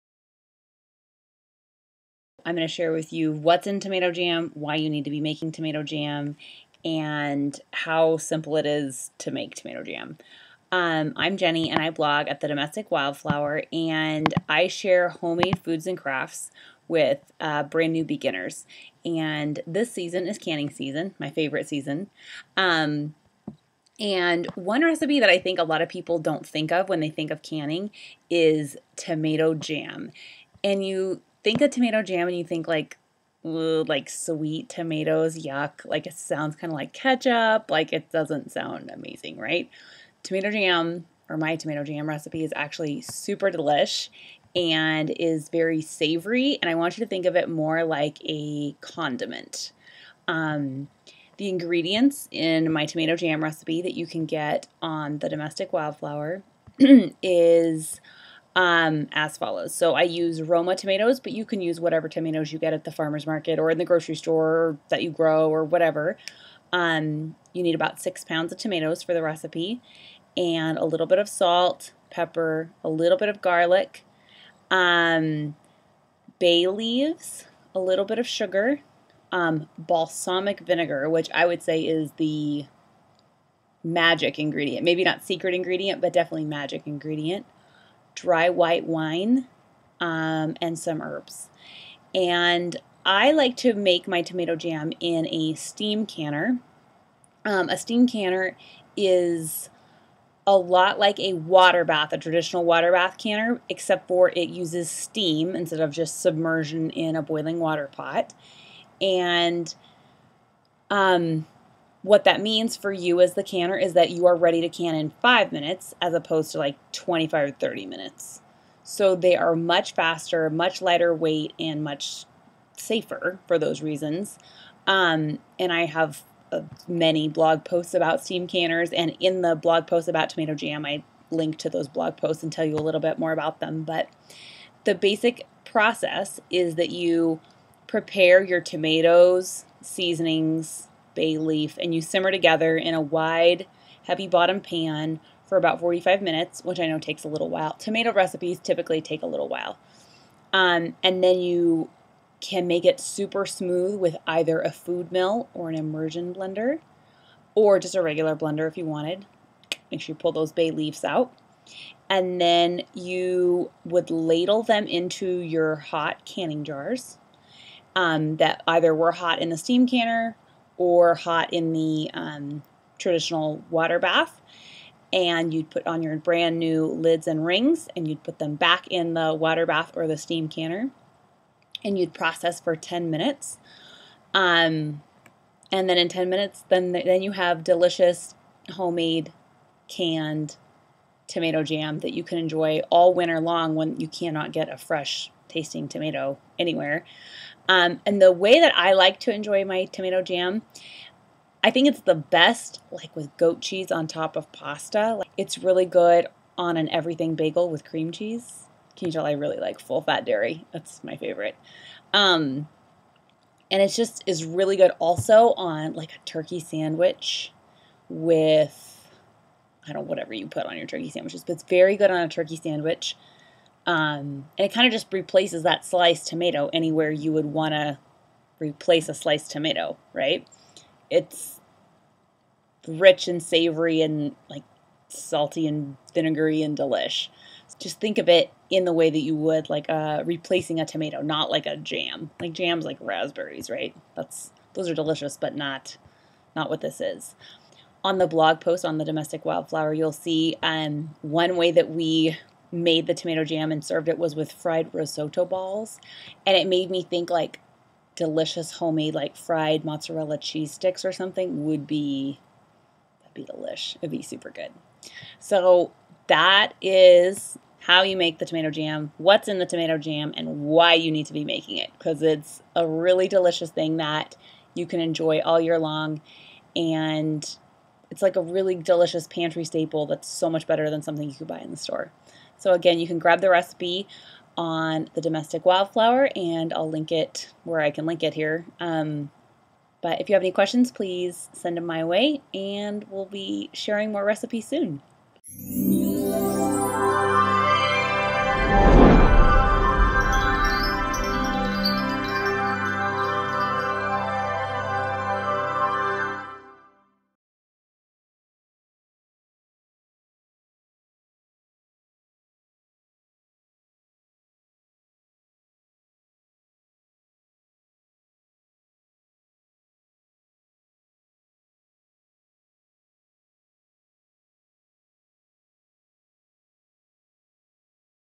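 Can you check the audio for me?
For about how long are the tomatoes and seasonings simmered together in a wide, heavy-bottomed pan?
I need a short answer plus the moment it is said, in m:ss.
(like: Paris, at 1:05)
45 minutes, at 2:25.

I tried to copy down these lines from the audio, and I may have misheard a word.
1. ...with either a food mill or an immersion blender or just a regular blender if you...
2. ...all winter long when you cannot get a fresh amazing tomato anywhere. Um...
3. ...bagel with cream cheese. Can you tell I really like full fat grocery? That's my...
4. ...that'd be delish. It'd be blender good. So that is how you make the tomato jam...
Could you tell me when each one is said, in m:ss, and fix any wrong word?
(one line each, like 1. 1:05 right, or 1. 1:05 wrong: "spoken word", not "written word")
1. 2:33 right
2. 3:12 wrong: "tasting", not "amazing"
3. 3:27 wrong: "dairy", not "grocery"
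4. 4:23 wrong: "super", not "blender".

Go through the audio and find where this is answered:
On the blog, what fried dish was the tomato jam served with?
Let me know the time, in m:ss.
4:14.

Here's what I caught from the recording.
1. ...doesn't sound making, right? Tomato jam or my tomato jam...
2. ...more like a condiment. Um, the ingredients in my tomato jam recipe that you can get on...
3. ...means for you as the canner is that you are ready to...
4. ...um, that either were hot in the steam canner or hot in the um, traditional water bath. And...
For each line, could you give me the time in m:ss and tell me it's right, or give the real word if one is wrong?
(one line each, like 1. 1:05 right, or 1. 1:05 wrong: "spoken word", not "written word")
1. 0:38 wrong: "amazing", not "making"
2. 0:47 right
3. 1:52 right
4. 2:47 right.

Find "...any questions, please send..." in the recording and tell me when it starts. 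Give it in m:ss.
4:50.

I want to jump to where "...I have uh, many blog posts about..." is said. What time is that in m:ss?
2:05.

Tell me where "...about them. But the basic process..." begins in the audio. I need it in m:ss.
2:13.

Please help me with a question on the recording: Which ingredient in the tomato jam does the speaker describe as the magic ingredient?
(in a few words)
Balsamic vinegar.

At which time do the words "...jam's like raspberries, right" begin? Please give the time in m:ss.
4:02.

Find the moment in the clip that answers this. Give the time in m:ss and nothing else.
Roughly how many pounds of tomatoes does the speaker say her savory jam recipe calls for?
1:08.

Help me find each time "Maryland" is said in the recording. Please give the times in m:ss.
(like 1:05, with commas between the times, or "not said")
not said.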